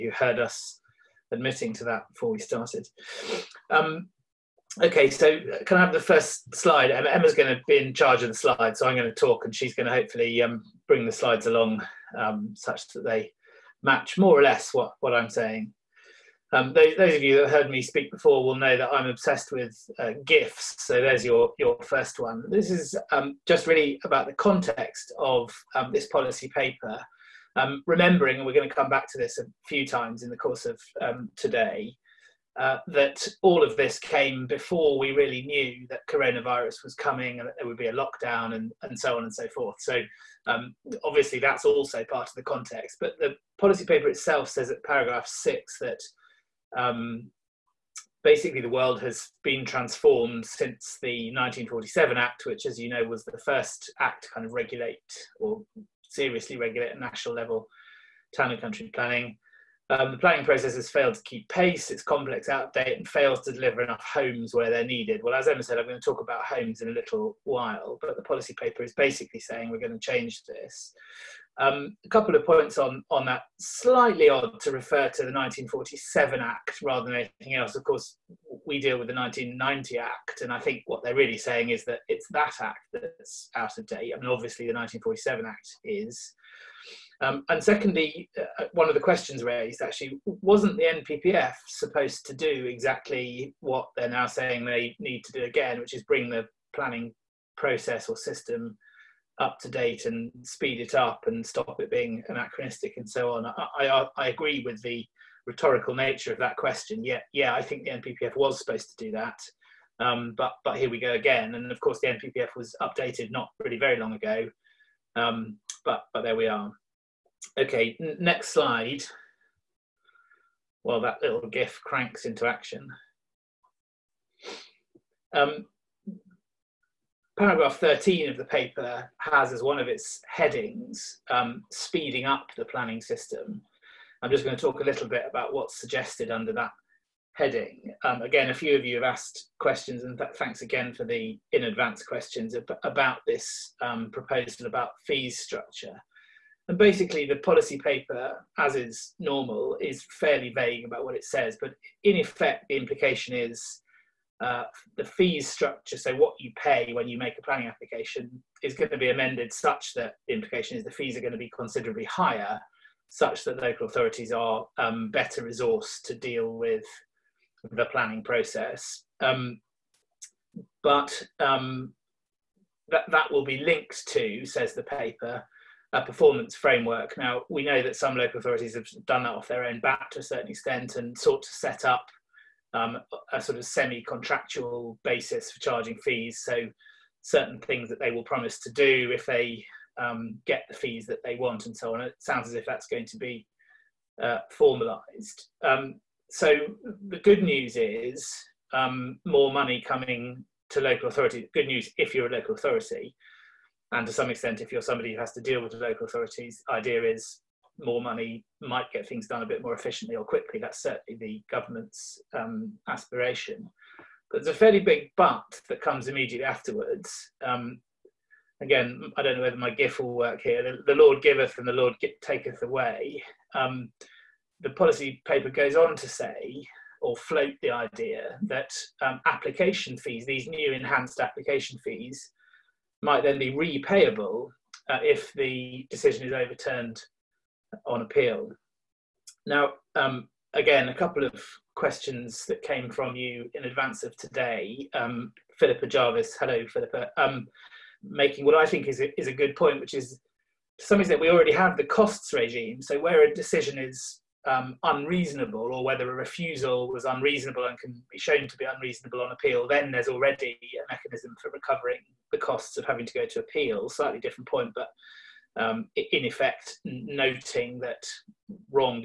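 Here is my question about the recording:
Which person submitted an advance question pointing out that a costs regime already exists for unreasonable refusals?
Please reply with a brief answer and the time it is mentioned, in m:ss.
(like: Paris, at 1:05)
Philippa Jarvis, at 4:05.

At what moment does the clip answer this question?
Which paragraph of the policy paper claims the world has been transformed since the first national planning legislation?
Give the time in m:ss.
0:45.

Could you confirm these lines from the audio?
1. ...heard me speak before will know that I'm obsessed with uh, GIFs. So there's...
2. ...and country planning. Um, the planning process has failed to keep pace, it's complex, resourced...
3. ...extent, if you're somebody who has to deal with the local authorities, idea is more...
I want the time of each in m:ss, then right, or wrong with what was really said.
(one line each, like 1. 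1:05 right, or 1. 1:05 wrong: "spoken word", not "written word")
1. 0:17 right
2. 0:58 wrong: "outdated", not "resourced"
3. 3:24 right.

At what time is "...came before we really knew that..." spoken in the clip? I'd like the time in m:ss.
0:33.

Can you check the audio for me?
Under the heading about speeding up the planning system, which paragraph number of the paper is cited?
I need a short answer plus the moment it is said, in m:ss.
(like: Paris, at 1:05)
13, at 2:07.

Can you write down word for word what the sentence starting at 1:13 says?
Slightly odd to refer to the 1947 Act rather than anything else.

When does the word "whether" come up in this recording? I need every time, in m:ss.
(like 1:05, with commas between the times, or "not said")
3:39, 4:15.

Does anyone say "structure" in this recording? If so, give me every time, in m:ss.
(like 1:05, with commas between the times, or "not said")
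2:25, 2:35.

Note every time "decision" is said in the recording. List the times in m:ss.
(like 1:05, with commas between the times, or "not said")
3:55, 4:13.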